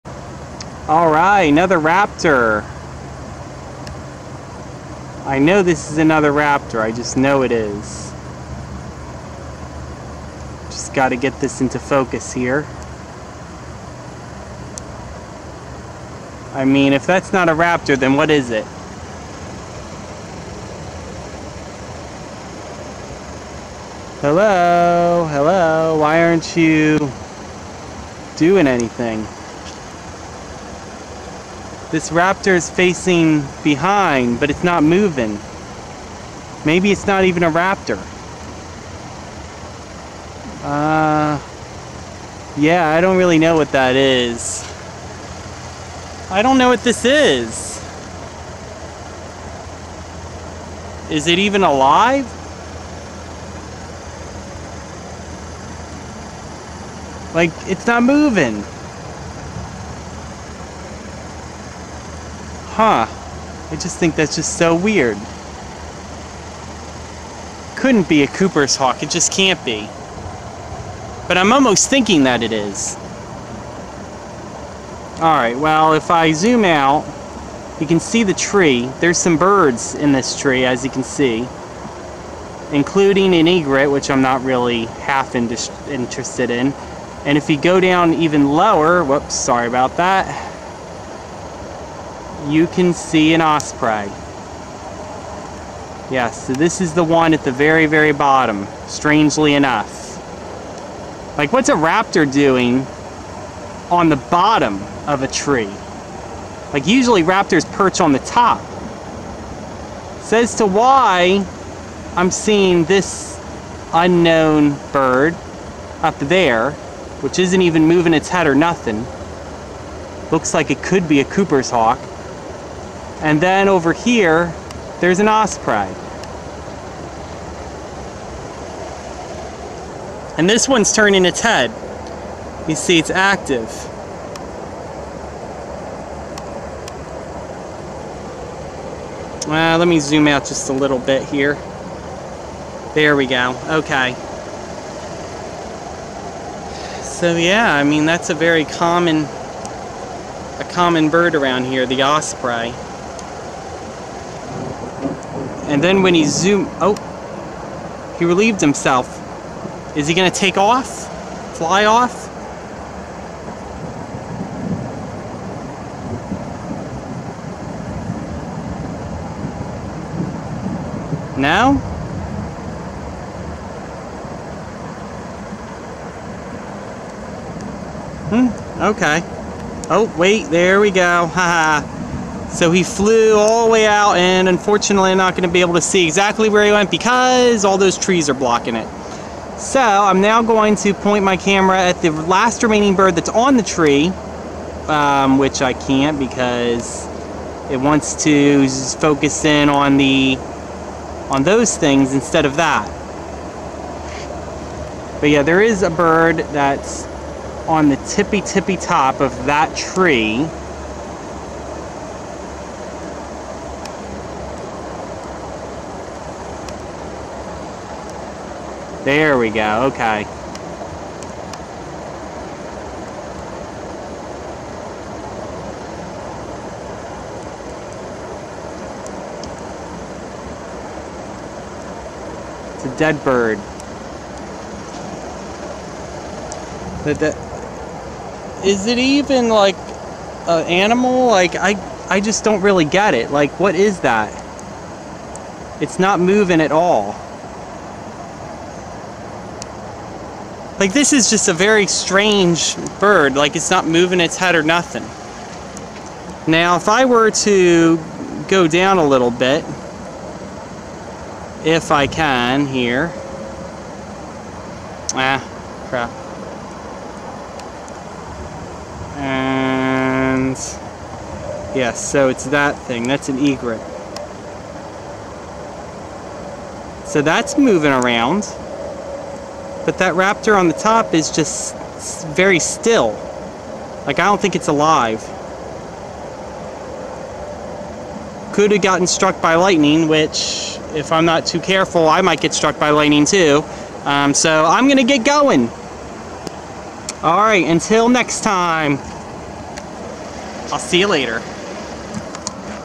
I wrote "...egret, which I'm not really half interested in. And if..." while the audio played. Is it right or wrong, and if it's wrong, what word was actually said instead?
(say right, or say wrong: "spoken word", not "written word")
right.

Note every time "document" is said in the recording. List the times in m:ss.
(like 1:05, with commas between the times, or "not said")
not said.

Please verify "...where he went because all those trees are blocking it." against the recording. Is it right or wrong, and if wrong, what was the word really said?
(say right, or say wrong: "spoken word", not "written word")
right.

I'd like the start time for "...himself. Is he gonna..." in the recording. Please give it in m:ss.
2:38.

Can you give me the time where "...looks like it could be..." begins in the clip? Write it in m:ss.
2:00.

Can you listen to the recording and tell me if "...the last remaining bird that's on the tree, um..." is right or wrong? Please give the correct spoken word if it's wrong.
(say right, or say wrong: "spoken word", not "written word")
right.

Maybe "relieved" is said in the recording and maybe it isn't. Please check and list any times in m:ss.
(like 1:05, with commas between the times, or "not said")
2:38.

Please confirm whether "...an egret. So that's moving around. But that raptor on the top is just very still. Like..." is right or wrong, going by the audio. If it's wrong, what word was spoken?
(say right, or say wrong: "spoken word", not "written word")
right.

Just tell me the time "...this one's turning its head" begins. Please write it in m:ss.
2:10.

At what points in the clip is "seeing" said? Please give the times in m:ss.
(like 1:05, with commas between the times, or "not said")
1:52.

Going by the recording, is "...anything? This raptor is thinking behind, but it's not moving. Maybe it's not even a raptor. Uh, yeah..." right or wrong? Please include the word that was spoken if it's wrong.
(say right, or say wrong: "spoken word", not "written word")
wrong: "facing", not "thinking".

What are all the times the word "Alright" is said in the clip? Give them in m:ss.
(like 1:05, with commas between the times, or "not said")
1:15, 4:57.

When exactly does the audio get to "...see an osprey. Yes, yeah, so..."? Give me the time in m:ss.
1:32.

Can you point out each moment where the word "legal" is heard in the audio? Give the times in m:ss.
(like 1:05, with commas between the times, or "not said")
not said.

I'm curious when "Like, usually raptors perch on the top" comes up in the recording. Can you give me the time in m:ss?
1:46.